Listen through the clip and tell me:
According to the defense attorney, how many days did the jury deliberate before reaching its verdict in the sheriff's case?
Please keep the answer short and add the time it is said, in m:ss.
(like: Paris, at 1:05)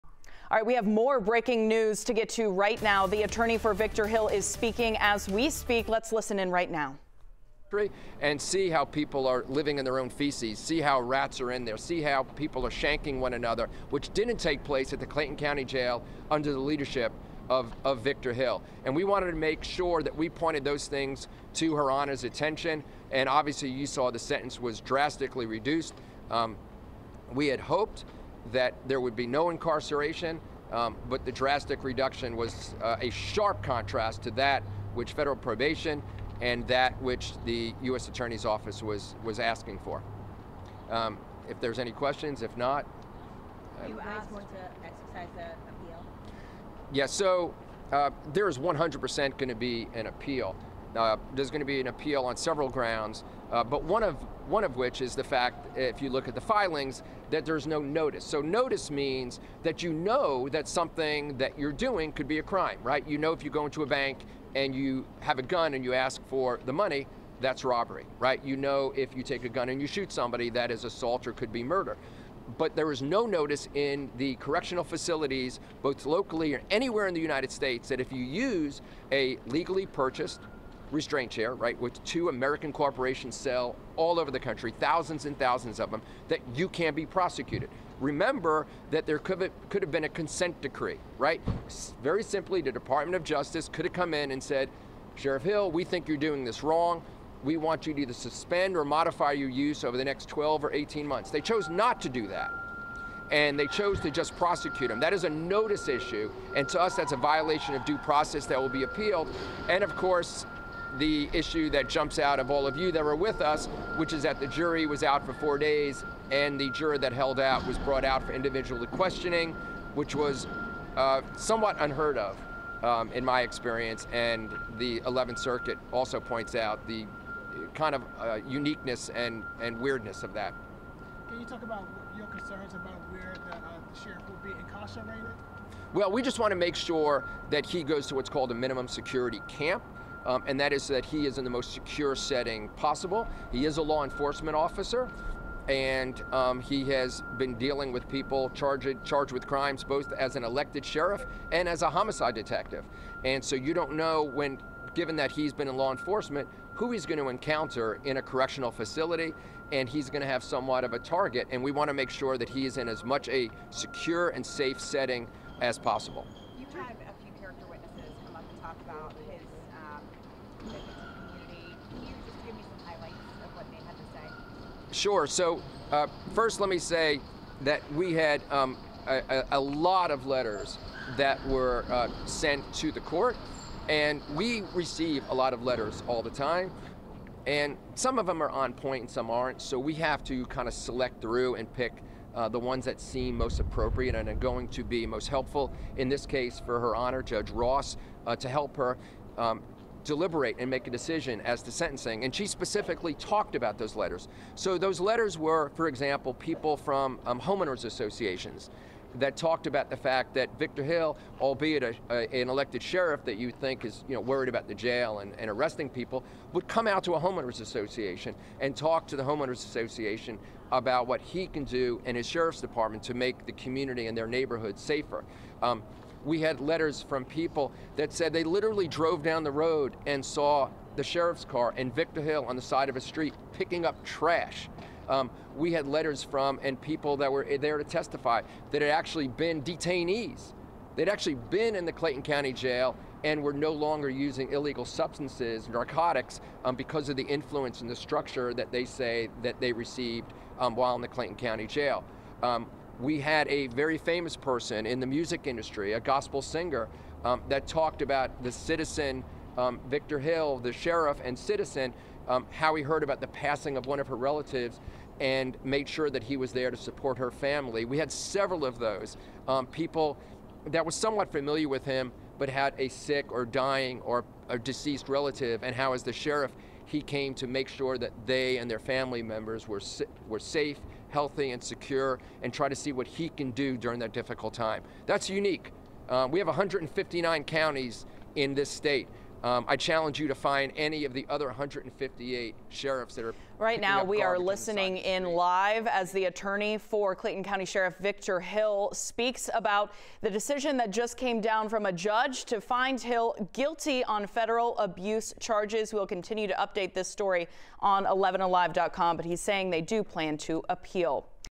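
4 days, at 1:55.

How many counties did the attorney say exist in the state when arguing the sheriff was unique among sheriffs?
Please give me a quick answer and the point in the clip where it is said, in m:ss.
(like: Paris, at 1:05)
159, at 4:46.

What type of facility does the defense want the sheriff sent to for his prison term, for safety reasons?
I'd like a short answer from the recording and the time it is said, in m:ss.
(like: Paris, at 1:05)
Minimum security camp, at 2:18.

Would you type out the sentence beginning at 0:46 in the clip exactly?
Yeah, so uh, there is 100% going to be an appeal.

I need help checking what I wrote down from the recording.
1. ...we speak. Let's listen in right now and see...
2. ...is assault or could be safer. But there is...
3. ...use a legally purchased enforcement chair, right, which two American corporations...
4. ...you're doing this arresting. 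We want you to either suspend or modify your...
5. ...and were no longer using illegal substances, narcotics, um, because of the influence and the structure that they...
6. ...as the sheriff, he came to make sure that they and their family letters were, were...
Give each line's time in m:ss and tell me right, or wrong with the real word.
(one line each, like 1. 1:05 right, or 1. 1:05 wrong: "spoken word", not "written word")
1. 0:05 right
2. 1:10 wrong: "murder", not "safer"
3. 1:18 wrong: "restraint", not "enforcement"
4. 1:36 wrong: "wrong", not "arresting"
5. 4:03 right
6. 4:35 wrong: "members", not "letters".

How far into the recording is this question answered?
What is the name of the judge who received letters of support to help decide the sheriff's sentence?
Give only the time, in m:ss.
3:17.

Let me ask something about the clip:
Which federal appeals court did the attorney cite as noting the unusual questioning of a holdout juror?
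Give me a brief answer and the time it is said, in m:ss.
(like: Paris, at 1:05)
11th Circuit, at 2:05.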